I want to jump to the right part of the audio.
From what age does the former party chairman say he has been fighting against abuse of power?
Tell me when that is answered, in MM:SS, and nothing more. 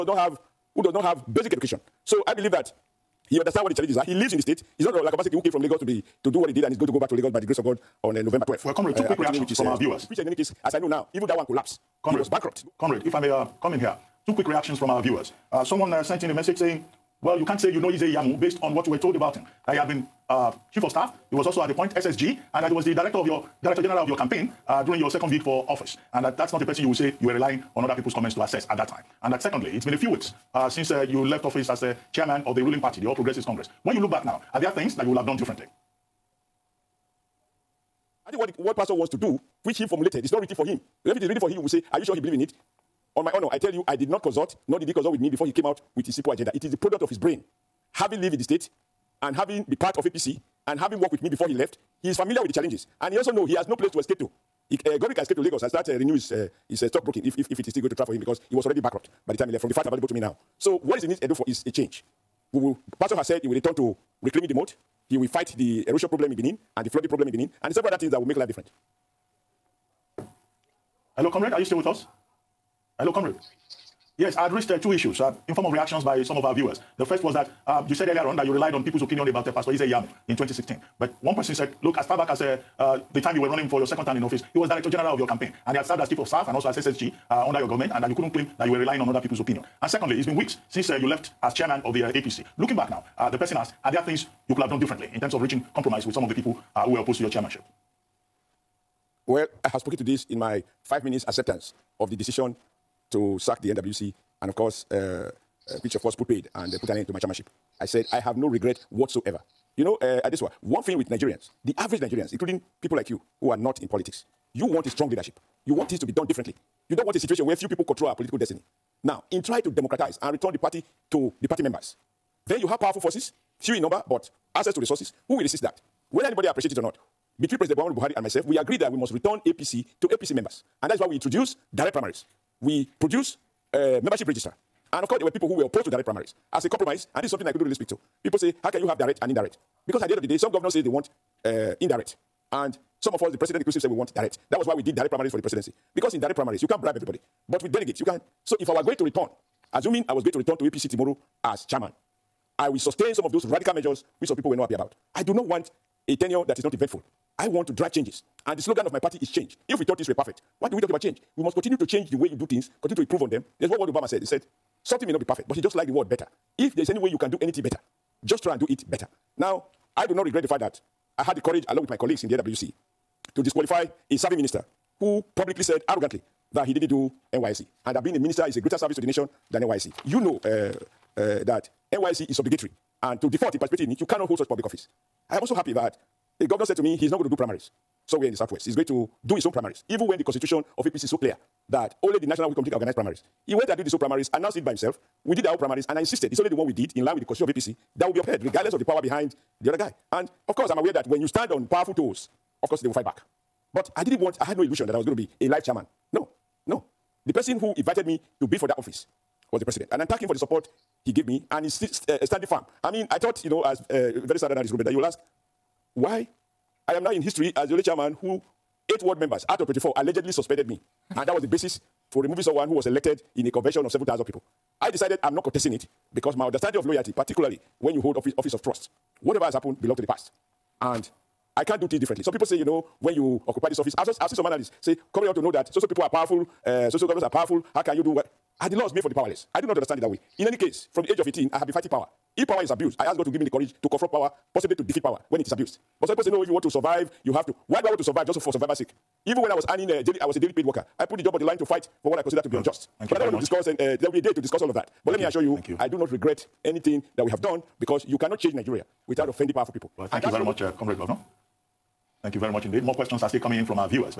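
04:01.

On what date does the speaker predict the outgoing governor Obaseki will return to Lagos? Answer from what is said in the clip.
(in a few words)
November 12th.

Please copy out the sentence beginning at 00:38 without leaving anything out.
I think what, the, what Pastor wants to do, which he formulated, is not written for him.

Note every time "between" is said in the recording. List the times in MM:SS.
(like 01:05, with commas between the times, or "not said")
02:07.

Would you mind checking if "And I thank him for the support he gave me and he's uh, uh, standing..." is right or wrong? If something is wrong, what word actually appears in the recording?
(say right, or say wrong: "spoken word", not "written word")
right.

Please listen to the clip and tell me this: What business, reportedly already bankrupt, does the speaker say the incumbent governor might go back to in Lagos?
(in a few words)
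Stockbroking.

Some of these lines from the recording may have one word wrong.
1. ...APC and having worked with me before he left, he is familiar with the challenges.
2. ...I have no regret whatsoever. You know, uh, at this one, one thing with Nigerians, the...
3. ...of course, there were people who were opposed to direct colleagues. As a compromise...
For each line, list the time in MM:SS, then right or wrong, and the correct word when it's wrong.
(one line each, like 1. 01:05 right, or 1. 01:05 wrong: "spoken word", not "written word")
1. 00:50 right
2. 01:48 right
3. 02:15 wrong: "primaries", not "colleagues".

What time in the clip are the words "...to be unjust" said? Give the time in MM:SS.
04:12.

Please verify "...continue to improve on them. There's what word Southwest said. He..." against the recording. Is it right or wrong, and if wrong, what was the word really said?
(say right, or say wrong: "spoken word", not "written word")
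wrong: "Obama", not "Southwest".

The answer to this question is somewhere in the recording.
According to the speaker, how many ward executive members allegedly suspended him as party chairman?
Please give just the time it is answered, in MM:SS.
03:38.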